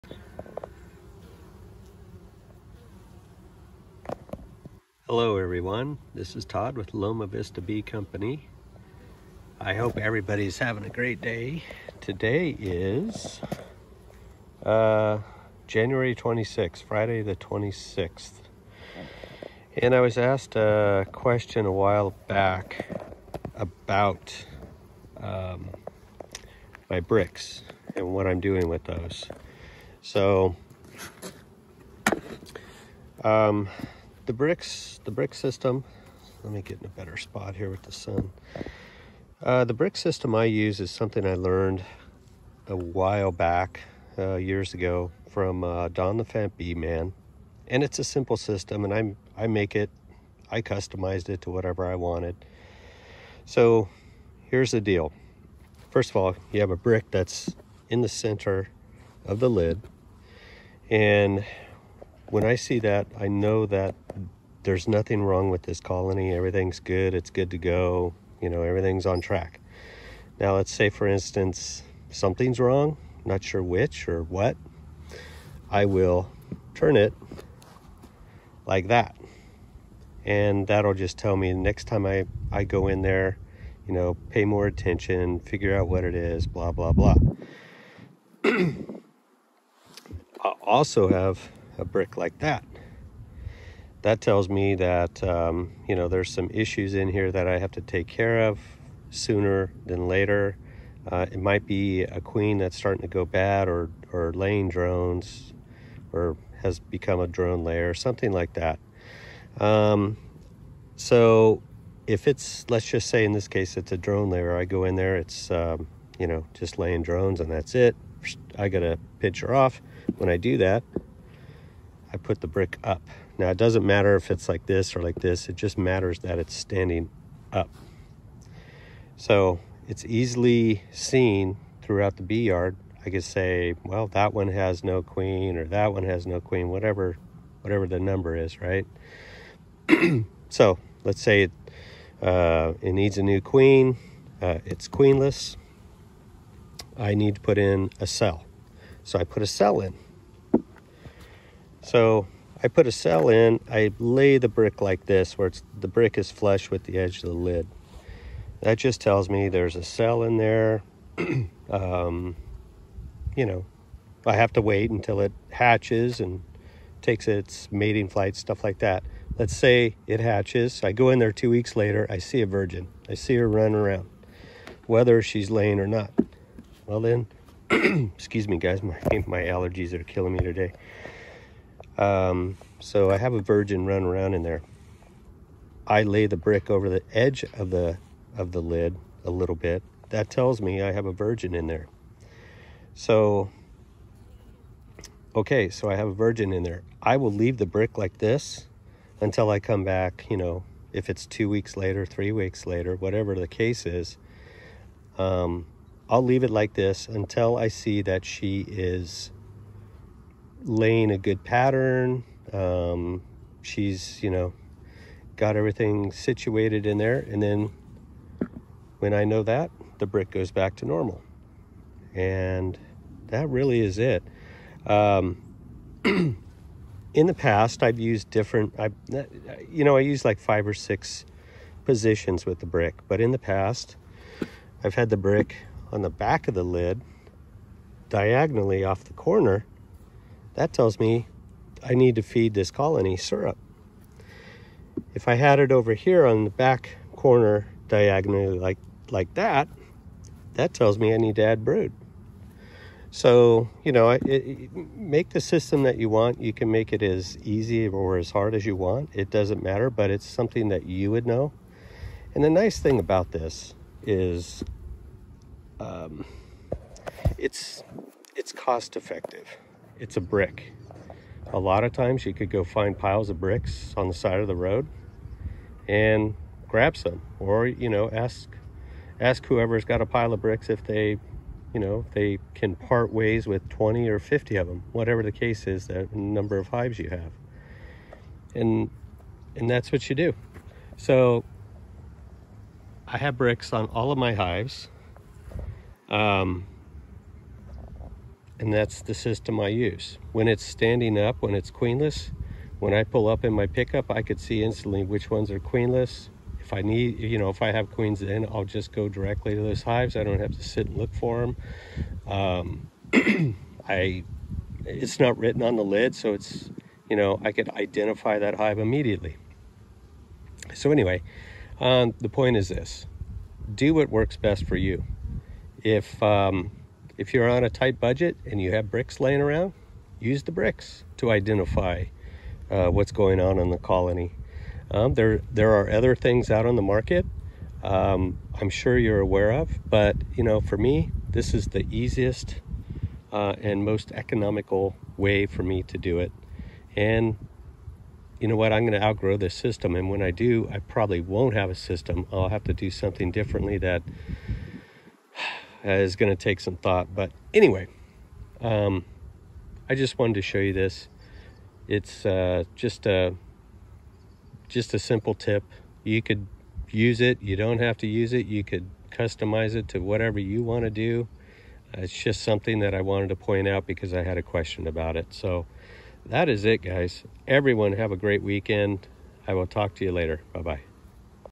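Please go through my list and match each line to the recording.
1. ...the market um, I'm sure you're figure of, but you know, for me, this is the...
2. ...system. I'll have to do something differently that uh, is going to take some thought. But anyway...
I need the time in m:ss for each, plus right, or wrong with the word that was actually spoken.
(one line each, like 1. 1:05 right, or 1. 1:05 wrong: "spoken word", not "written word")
1. 5:36 wrong: "aware", not "figure"
2. 5:51 right.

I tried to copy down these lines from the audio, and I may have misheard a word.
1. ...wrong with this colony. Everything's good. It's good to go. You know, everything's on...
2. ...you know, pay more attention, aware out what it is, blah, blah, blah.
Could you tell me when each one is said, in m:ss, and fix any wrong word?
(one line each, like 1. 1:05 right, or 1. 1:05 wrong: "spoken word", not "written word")
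1. 1:05 right
2. 1:23 wrong: "figure", not "aware".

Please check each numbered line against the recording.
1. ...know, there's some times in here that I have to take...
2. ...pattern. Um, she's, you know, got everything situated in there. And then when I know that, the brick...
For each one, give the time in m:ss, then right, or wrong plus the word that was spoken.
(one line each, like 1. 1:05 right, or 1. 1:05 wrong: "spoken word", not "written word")
1. 1:35 wrong: "issues", not "times"
2. 3:31 right.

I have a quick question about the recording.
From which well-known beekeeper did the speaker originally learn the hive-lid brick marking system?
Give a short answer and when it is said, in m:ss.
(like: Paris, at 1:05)
Don the Fat Bee Man, at 0:45.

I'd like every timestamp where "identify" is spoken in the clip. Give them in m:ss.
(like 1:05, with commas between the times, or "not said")
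5:17, 5:31.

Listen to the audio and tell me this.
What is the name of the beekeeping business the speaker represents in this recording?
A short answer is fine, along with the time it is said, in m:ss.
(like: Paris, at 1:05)
Loma Vista Bee Company, at 0:06.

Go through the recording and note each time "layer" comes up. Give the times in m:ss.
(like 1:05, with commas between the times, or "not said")
1:47, 1:54.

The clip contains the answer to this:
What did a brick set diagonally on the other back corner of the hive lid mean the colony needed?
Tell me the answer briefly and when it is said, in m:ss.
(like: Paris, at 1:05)
Brood, at 4:11.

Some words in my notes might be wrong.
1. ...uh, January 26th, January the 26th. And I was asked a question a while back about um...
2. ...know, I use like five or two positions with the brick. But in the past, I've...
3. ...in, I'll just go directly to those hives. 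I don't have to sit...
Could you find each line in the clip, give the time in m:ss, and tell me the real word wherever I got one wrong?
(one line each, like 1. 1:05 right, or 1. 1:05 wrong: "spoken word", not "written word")
1. 0:14 wrong: "Friday", not "January"
2. 3:49 wrong: "six", not "two"
3. 5:08 right.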